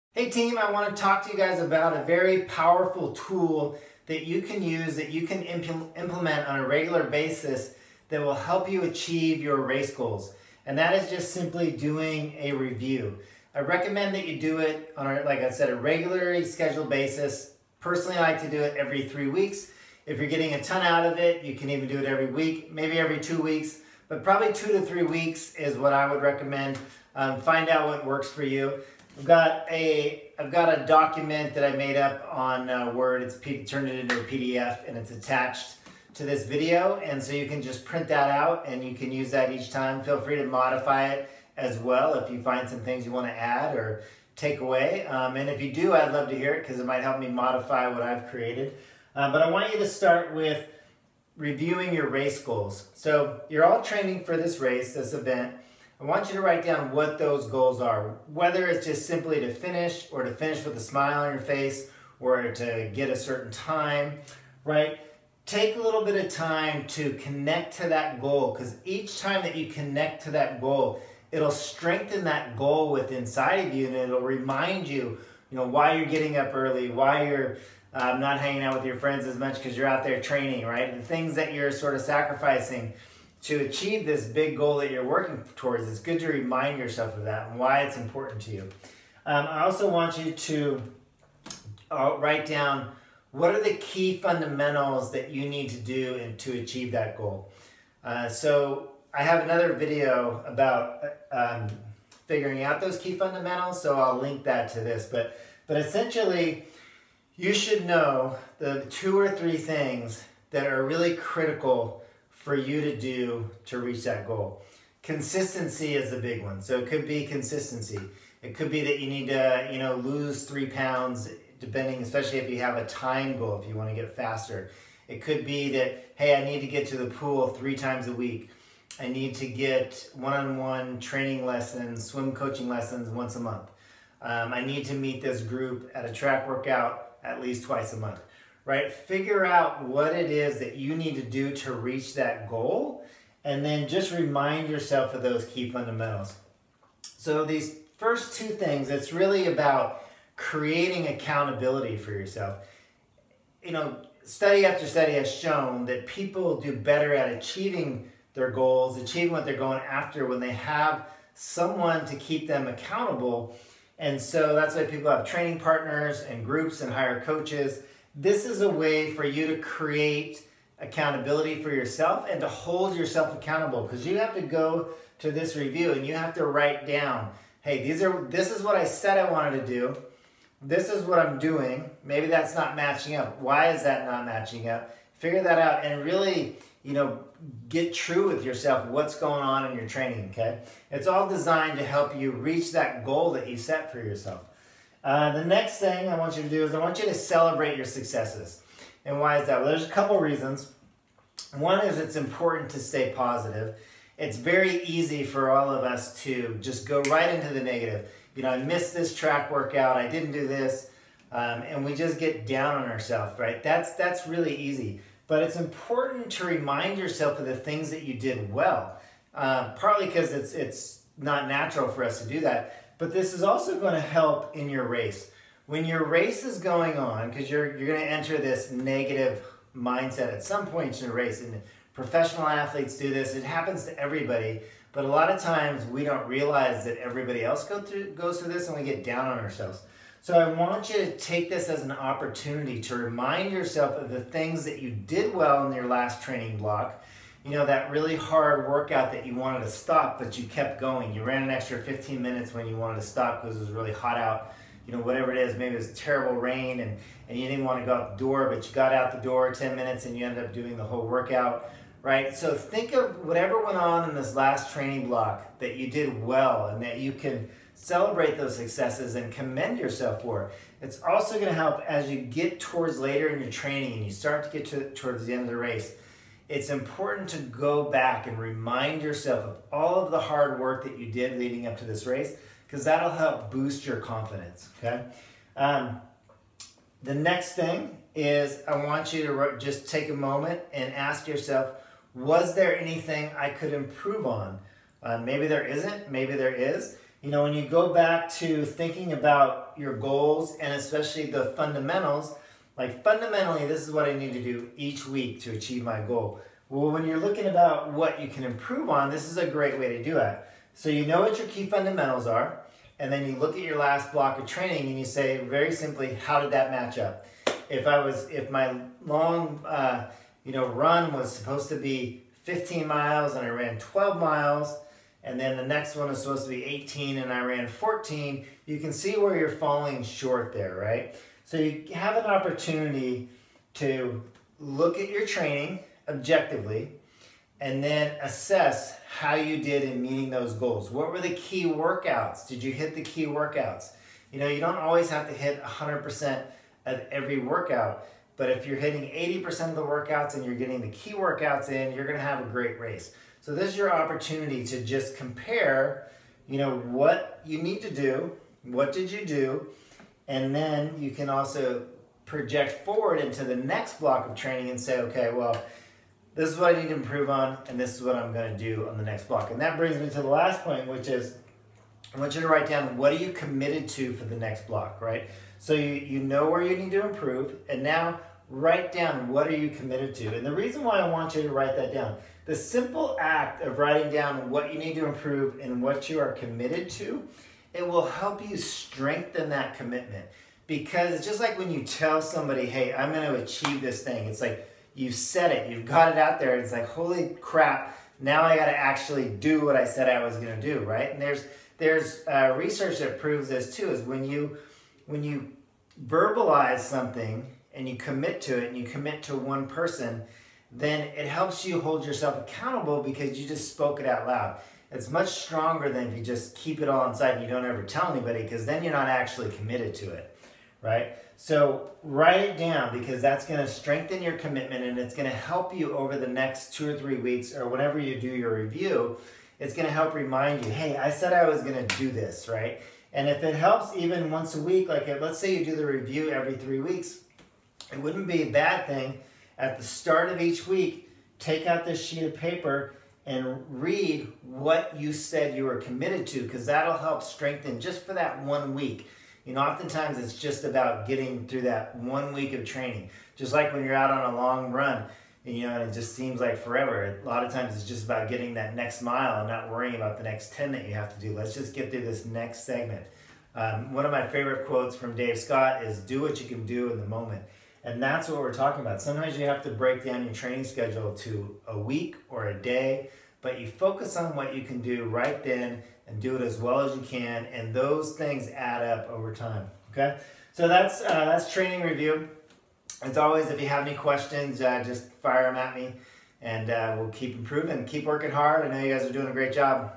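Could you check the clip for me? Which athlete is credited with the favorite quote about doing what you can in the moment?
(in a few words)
Dave Scott.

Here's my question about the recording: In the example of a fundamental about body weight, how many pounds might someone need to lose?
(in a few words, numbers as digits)
3.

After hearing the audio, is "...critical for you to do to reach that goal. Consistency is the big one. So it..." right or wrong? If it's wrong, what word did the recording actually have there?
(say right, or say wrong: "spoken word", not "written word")
right.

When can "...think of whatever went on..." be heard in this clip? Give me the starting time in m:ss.
4:22.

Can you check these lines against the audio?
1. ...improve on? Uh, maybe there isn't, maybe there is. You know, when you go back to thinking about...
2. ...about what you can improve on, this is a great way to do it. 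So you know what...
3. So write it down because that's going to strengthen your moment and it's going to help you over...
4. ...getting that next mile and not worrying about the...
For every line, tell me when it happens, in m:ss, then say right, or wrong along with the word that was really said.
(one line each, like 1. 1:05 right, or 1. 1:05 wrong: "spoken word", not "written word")
1. 4:53 right
2. 5:07 right
3. 7:01 wrong: "commitment", not "moment"
4. 7:38 right.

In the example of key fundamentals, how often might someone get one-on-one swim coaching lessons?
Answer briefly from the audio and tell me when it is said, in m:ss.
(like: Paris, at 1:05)
Once a month, at 2:13.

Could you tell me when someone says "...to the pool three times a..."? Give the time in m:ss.
2:06.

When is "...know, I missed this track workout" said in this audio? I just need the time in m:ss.
3:28.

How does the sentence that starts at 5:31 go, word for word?
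So you have an opportunity to look at your training objectively and then assess how you did in meeting those goals.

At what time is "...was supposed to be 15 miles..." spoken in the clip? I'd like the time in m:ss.
5:21.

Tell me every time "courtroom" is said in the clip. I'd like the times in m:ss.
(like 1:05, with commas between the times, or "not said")
not said.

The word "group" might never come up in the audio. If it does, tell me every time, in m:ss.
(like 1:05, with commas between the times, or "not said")
2:15, 2:46.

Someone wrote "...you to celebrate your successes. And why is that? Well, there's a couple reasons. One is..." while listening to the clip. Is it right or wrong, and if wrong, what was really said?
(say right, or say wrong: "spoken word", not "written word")
right.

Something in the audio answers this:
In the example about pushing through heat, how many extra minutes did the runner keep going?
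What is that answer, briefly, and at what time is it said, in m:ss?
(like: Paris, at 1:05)
15, at 4:11.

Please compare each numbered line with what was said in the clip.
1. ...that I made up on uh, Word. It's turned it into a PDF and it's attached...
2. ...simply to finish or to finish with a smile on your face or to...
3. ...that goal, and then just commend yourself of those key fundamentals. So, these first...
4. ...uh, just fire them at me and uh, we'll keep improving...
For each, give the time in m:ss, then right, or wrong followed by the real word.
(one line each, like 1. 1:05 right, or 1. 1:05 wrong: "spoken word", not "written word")
1. 0:31 right
2. 0:59 right
3. 2:22 wrong: "remind", not "commend"
4. 8:04 right.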